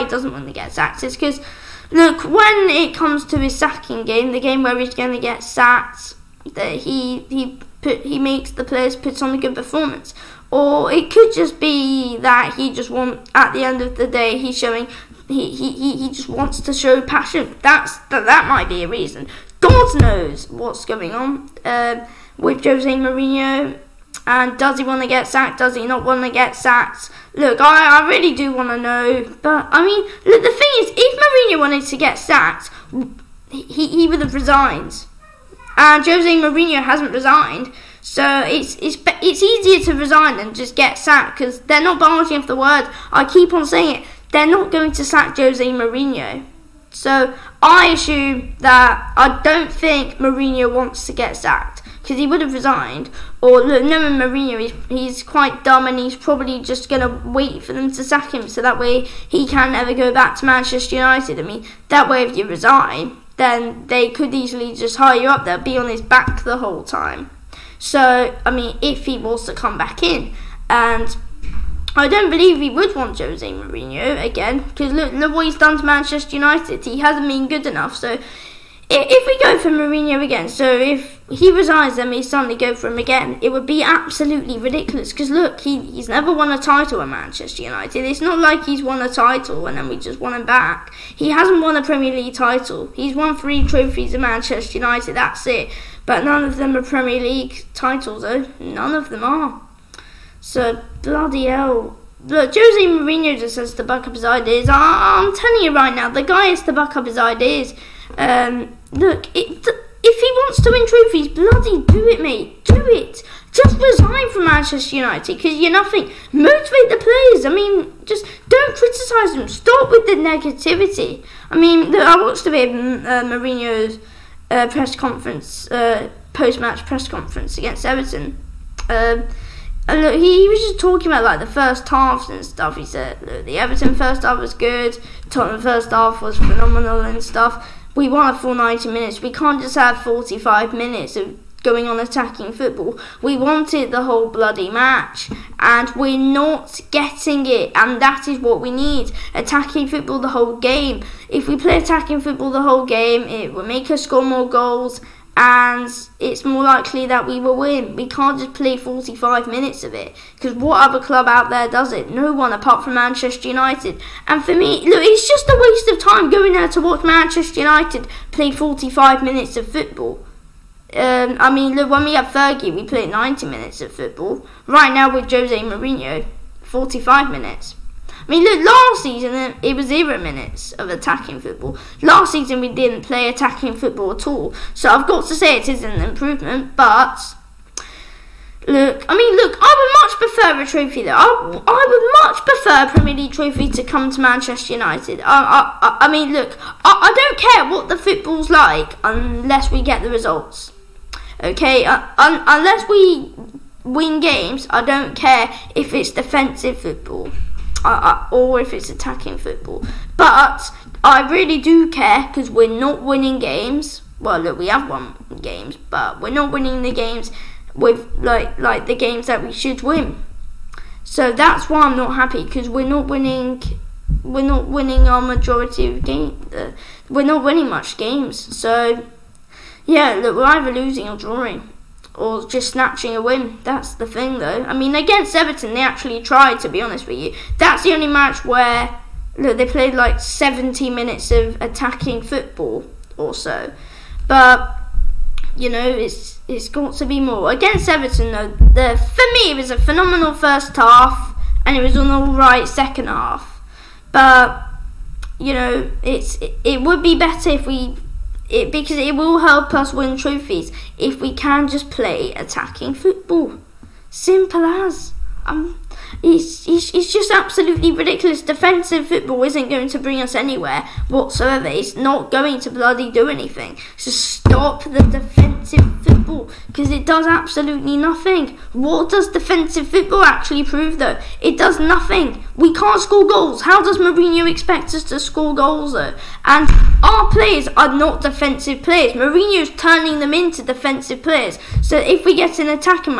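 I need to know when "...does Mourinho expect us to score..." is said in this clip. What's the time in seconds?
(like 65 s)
283 s.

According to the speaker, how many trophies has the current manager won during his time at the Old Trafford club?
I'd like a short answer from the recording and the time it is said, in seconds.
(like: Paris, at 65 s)
3, at 93 s.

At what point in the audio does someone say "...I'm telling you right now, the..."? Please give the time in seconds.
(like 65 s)
105 s.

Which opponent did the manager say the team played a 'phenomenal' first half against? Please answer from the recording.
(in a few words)
Tottenham.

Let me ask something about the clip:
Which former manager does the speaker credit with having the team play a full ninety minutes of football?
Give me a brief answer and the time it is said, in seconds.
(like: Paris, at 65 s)
Fergie, at 172 s.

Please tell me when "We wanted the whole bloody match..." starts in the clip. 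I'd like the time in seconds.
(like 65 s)
143 s.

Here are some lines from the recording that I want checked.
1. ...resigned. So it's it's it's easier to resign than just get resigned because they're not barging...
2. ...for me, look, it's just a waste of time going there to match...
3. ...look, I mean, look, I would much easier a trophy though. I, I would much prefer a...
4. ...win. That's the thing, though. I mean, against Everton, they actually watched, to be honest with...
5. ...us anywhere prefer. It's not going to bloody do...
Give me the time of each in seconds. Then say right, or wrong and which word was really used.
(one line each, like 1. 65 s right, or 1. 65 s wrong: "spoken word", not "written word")
1. 37 s wrong: "sacked", not "resigned"
2. 164 s wrong: "watch", not "match"
3. 188 s wrong: "prefer", not "easier"
4. 233 s wrong: "tried", not "watched"
5. 270 s wrong: "whatsoever", not "prefer".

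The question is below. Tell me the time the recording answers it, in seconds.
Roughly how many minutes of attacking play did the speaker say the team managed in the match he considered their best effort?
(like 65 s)
240 s.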